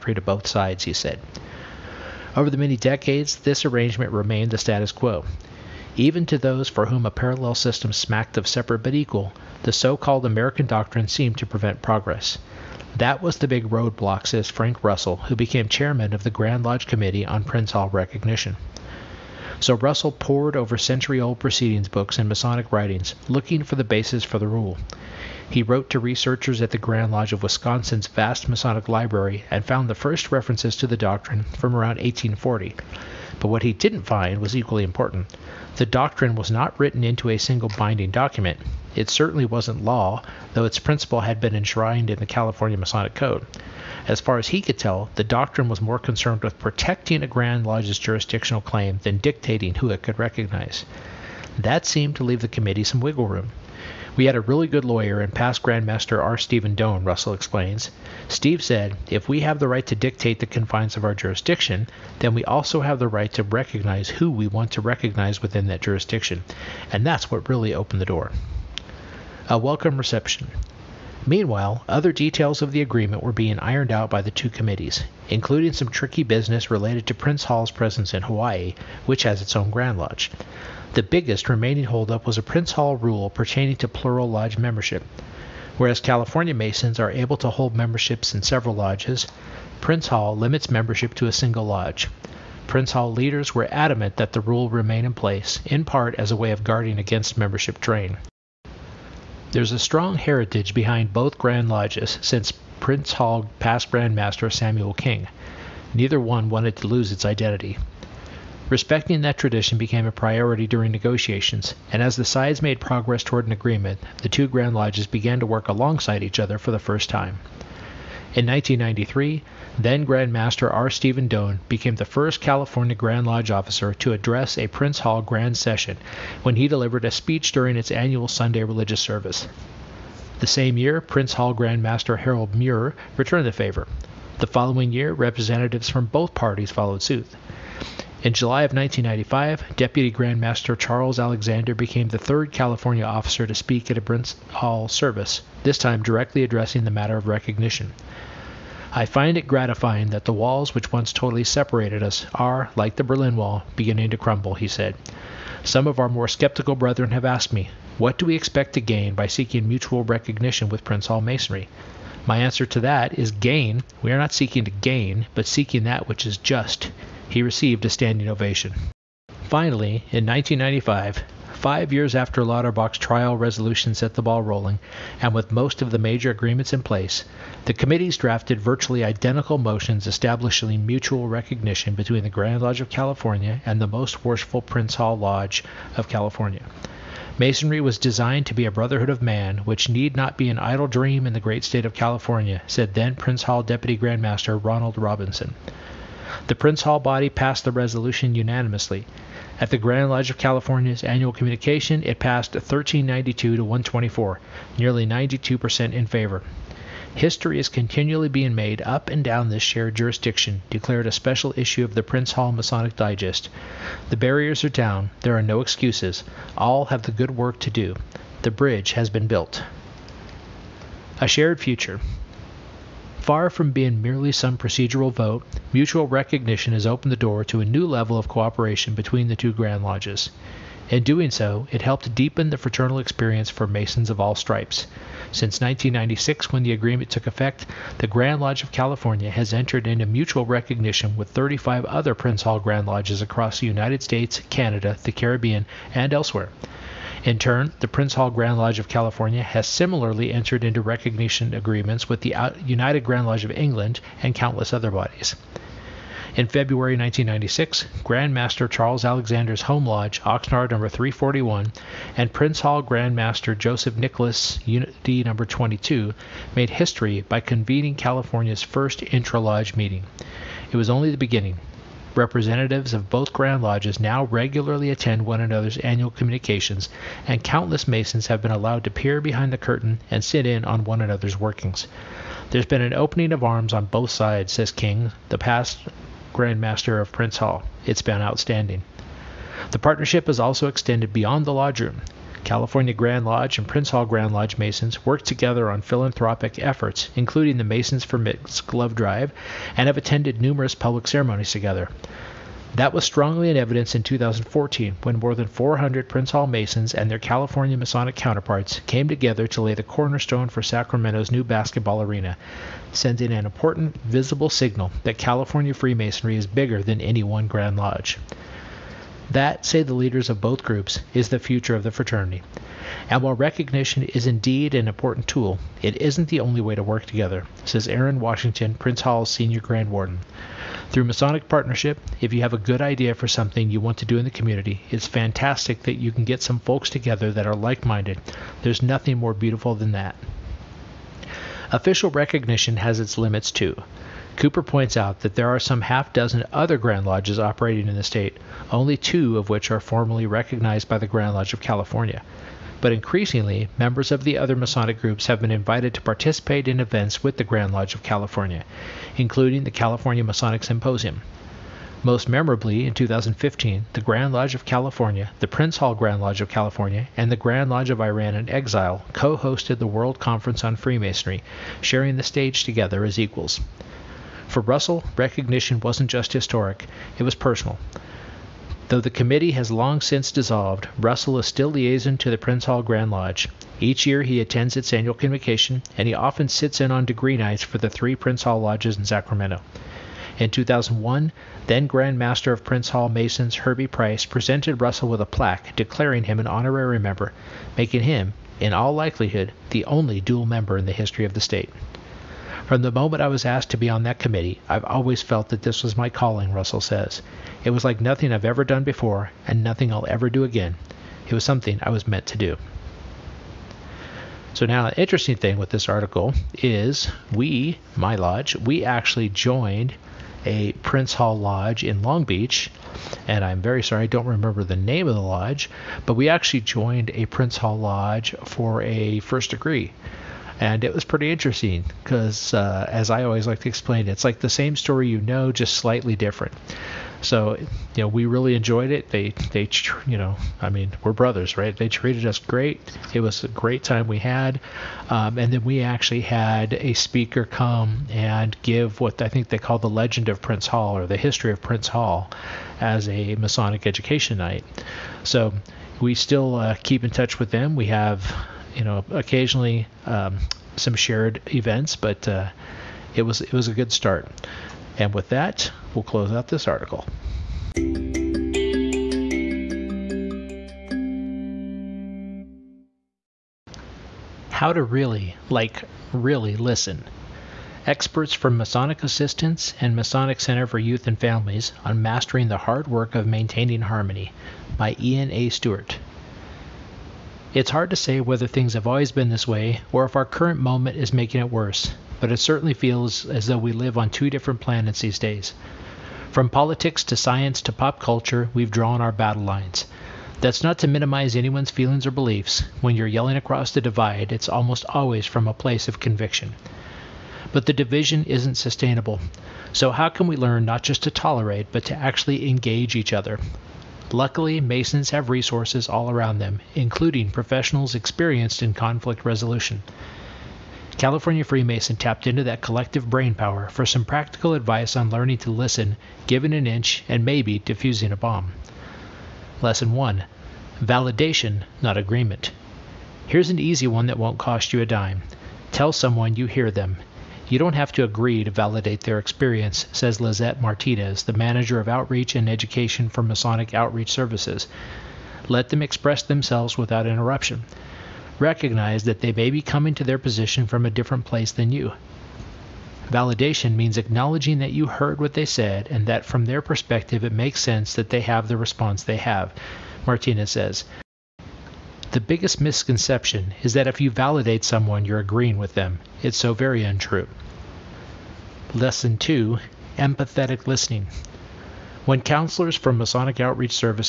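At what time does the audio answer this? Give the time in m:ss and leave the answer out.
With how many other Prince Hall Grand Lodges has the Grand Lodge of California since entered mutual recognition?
4:01.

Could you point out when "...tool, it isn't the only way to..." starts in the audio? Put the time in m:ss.
5:25.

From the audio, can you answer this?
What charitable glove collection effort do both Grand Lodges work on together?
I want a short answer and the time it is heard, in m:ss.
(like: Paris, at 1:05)
Masons for Mitts, at 4:57.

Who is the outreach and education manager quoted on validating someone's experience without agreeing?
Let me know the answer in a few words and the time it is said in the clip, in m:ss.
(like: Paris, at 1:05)
Lizette Martinez, at 9:00.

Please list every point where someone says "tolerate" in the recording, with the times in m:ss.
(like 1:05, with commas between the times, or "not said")
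8:31.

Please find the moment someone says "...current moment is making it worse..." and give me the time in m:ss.
8:10.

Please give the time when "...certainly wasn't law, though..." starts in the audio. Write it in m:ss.
0:39.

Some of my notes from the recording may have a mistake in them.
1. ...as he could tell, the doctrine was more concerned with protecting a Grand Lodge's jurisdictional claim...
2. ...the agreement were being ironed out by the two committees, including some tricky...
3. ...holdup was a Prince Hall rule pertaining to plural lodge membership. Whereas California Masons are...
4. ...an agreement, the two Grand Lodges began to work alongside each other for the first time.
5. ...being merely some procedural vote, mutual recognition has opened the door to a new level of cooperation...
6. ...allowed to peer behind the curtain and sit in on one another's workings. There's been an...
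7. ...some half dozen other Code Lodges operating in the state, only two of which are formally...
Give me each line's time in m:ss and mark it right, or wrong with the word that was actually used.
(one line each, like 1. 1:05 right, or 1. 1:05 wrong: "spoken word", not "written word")
1. 0:44 right
2. 1:12 right
3. 1:21 right
4. 1:53 right
5. 3:43 right
6. 4:38 right
7. 5:45 wrong: "Grand", not "Code".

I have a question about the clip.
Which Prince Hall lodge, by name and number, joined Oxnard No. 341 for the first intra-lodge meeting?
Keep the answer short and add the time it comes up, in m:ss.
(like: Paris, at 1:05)
Unity No. 22, at 4:24.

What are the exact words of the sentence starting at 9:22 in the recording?
The biggest misconception is that if you validate someone, you're agreeing with them.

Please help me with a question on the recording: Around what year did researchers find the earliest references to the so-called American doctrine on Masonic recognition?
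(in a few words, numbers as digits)
1840.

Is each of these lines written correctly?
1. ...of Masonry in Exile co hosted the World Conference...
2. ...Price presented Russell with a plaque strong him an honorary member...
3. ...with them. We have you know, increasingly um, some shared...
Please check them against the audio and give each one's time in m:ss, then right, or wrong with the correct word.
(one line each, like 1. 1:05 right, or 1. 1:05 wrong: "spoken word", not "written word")
1. 6:07 wrong: "Iran", not "Masonry"
2. 6:33 wrong: "declaring", not "strong"
3. 7:37 wrong: "occasionally", not "increasingly".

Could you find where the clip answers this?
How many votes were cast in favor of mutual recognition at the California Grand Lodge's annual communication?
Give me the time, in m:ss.
3:22.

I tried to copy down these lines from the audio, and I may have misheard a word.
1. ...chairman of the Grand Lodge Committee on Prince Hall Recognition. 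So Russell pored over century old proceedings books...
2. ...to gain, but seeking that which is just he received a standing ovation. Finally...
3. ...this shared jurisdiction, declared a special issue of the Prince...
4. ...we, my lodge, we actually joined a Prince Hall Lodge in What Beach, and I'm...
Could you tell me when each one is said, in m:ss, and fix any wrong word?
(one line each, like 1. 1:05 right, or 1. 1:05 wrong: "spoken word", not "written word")
1. 0:15 right
2. 2:44 right
3. 3:29 right
4. 6:57 wrong: "Long", not "What".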